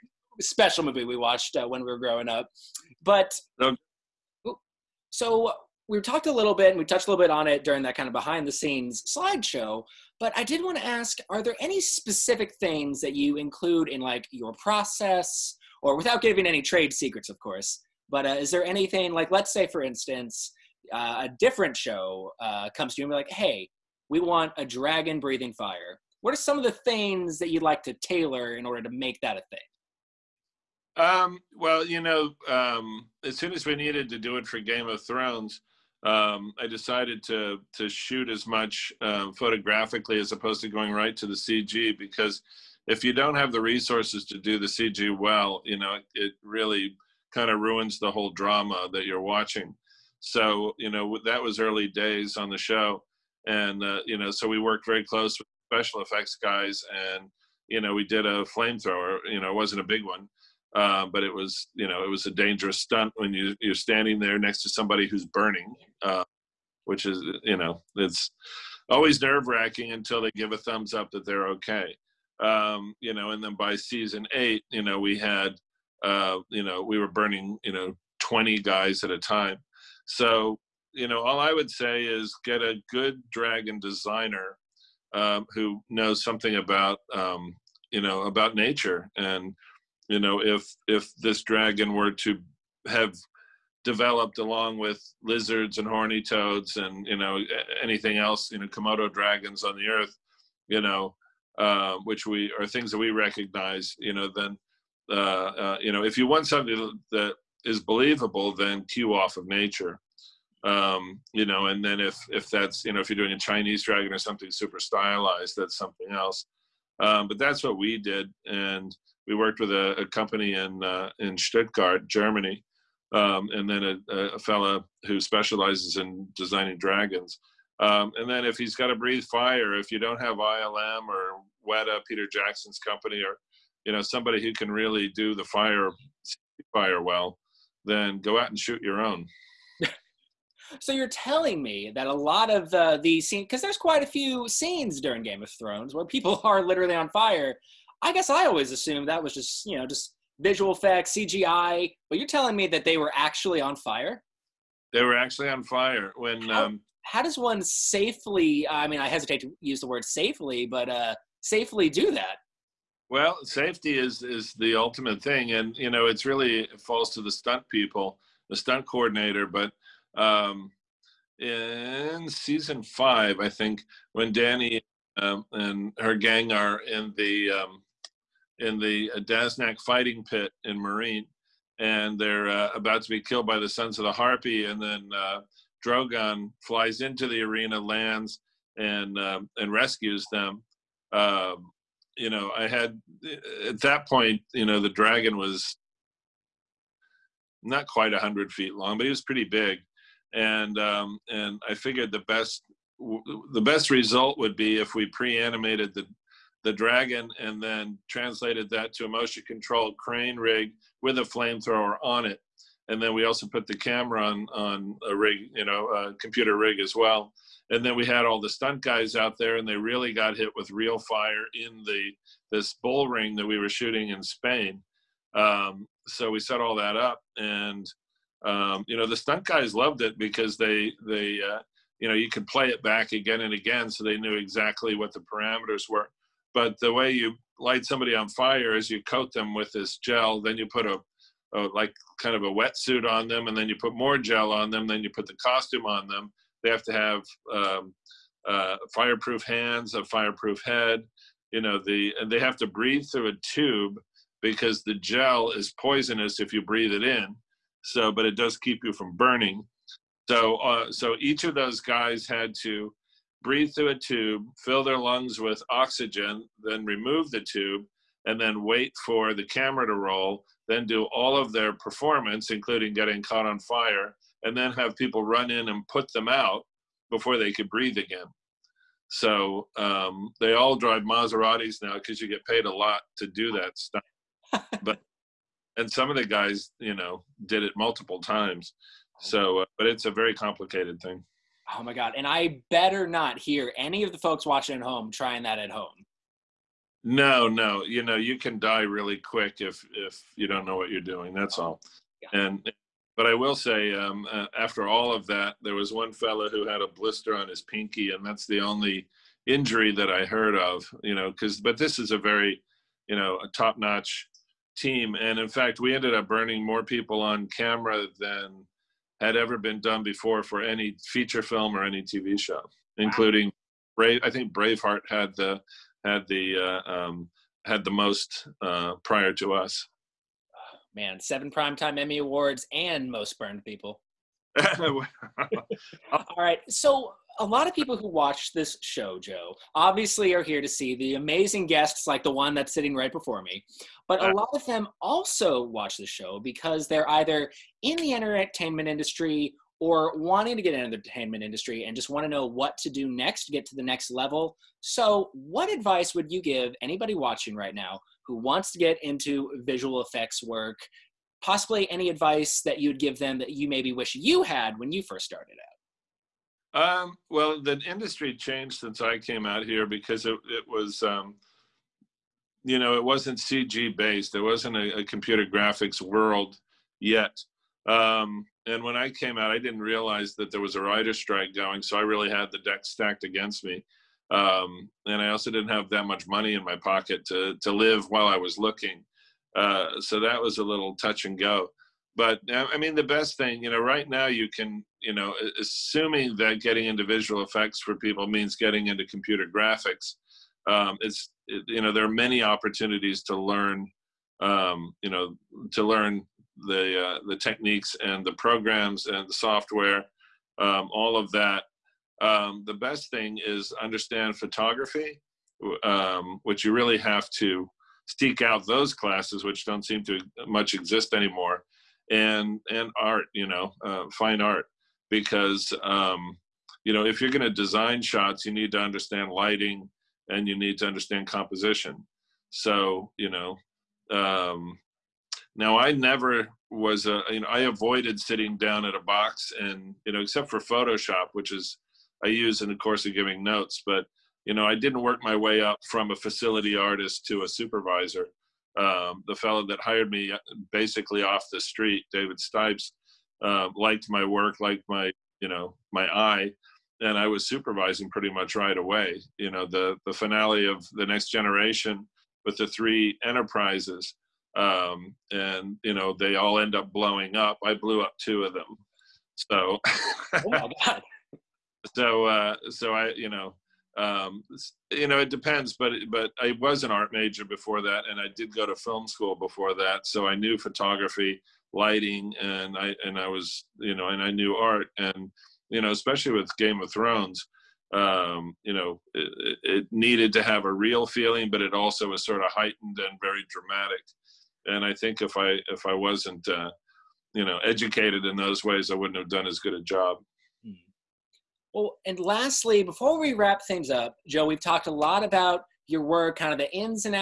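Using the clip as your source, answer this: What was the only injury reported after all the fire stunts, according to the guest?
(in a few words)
a blister on his pinky.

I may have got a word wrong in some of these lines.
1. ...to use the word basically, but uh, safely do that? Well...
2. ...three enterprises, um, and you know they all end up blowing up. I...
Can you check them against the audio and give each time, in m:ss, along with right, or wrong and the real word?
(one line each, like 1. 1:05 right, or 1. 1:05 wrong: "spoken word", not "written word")
1. 2:39 wrong: "safely", not "basically"
2. 7:42 right.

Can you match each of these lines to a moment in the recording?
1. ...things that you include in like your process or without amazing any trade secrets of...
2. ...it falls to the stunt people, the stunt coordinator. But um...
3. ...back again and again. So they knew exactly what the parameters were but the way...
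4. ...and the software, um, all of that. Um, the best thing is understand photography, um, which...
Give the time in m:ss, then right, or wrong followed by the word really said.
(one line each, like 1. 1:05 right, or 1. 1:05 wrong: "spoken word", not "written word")
1. 0:12 wrong: "giving", not "amazing"
2. 2:46 right
3. 3:52 right
4. 6:49 right.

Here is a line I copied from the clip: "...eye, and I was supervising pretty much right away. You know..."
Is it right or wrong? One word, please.
right.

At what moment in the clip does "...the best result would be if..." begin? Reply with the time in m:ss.
3:23.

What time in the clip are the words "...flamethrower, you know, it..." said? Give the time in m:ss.
0:58.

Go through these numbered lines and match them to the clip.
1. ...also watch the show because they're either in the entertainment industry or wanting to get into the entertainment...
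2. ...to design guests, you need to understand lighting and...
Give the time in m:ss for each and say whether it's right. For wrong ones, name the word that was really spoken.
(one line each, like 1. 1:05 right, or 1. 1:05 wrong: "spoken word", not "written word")
1. 5:45 right
2. 7:07 wrong: "shots", not "guests".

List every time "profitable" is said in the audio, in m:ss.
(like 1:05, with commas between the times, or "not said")
not said.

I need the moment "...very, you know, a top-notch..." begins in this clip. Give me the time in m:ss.
5:12.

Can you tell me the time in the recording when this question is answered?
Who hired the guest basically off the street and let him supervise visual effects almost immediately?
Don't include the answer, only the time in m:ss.
7:32.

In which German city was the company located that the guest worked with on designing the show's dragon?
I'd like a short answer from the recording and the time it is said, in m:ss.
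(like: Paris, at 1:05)
Stuttgart, at 2:01.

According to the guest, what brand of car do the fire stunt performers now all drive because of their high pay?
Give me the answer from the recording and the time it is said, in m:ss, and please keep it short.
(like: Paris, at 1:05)
Maseratis, at 4:41.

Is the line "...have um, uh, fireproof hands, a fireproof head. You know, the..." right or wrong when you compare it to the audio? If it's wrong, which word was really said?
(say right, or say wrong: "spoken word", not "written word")
right.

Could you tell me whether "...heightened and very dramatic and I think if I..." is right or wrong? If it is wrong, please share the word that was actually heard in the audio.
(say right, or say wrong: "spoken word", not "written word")
right.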